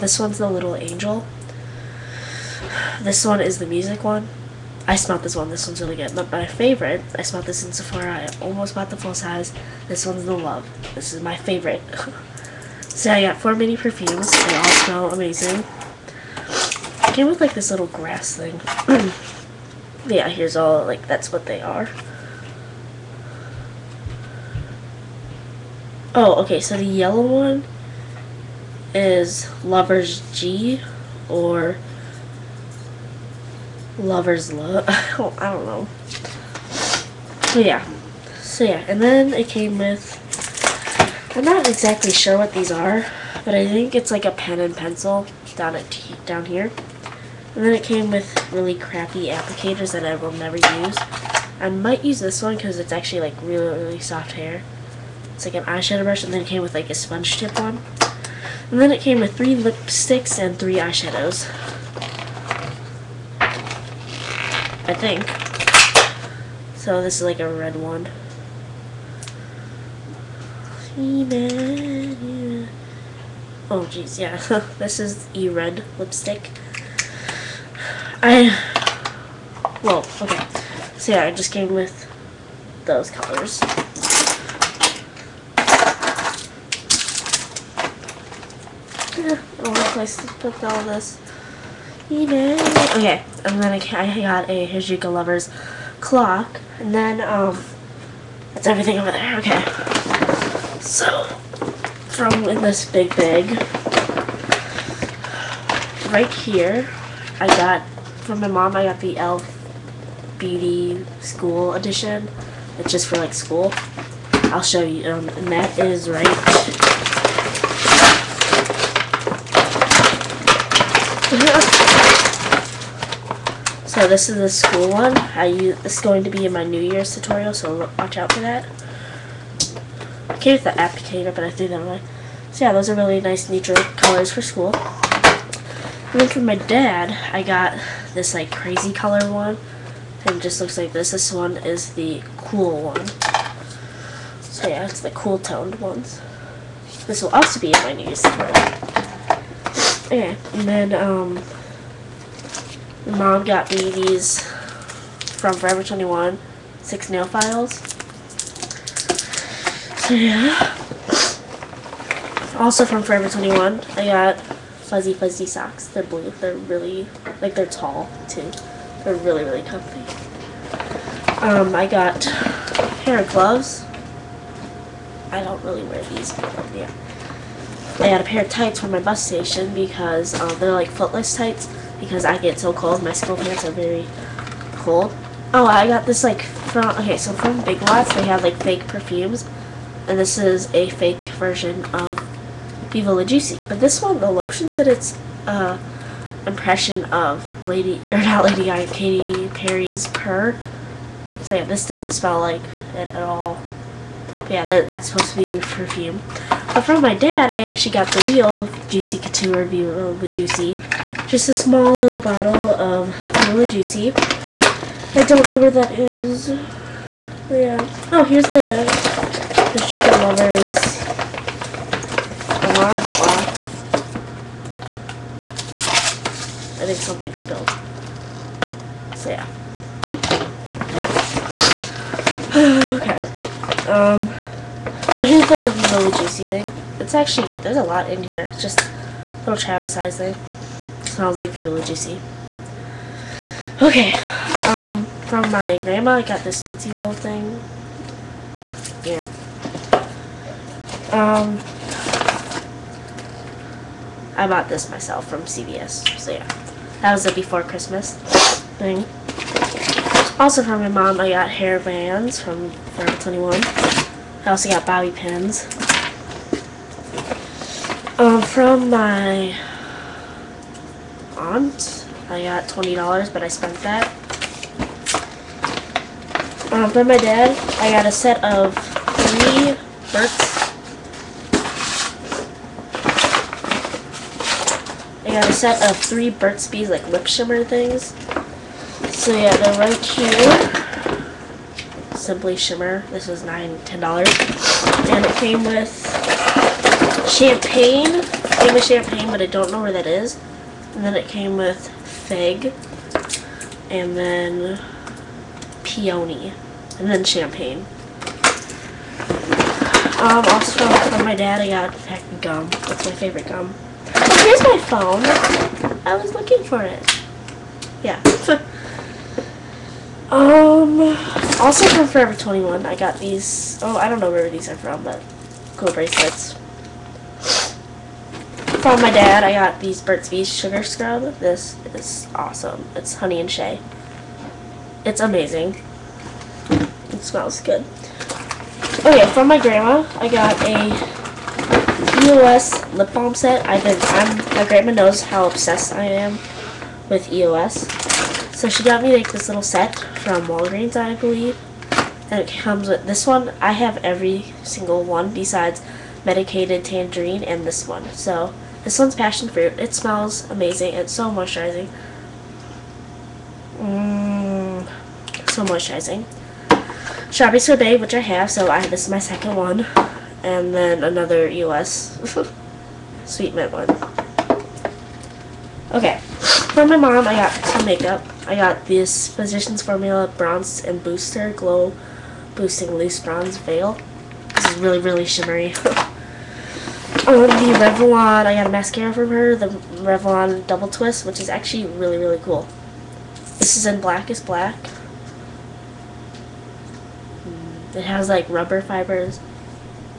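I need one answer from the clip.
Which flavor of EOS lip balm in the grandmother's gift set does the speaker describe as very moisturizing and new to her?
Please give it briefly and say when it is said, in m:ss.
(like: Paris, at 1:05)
Passion fruit, at 5:59.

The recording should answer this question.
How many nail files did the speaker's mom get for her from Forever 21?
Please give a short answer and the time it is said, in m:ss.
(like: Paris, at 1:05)
6, at 2:36.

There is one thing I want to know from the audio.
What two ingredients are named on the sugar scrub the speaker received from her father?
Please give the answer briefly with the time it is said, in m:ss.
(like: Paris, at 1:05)
Honey and shea, at 5:33.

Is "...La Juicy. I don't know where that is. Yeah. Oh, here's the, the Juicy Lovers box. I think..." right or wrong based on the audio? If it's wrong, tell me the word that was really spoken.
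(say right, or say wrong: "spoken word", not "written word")
right.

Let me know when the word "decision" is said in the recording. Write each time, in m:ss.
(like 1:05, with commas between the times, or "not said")
not said.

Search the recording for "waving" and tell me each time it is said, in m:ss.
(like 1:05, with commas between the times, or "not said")
not said.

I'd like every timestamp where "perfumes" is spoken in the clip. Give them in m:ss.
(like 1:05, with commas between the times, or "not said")
0:13, 3:08, 3:25.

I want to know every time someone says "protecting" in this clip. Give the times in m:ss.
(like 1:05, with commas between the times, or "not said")
not said.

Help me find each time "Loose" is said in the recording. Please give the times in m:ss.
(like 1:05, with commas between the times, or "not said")
6:22.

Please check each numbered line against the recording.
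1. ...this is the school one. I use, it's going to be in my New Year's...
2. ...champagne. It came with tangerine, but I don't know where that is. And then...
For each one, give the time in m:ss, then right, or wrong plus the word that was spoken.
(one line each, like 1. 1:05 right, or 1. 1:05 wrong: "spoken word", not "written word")
1. 2:04 right
2. 4:57 wrong: "champagne", not "tangerine".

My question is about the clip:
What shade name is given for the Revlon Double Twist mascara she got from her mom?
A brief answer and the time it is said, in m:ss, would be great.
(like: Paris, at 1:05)
Black is Black, at 6:34.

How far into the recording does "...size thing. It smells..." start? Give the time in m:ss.
3:59.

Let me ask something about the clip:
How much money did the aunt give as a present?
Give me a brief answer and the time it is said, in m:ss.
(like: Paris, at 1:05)
$20, at 4:32.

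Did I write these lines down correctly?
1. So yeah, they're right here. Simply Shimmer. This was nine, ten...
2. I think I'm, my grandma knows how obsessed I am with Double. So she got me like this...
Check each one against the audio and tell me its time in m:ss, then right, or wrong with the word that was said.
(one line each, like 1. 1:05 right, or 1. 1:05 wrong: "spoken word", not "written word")
1. 4:49 right
2. 5:43 wrong: "EOS", not "Double".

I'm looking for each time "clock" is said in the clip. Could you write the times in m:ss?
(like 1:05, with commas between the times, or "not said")
1:36.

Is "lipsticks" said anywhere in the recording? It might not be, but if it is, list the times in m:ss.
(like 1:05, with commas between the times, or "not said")
0:59, 1:15.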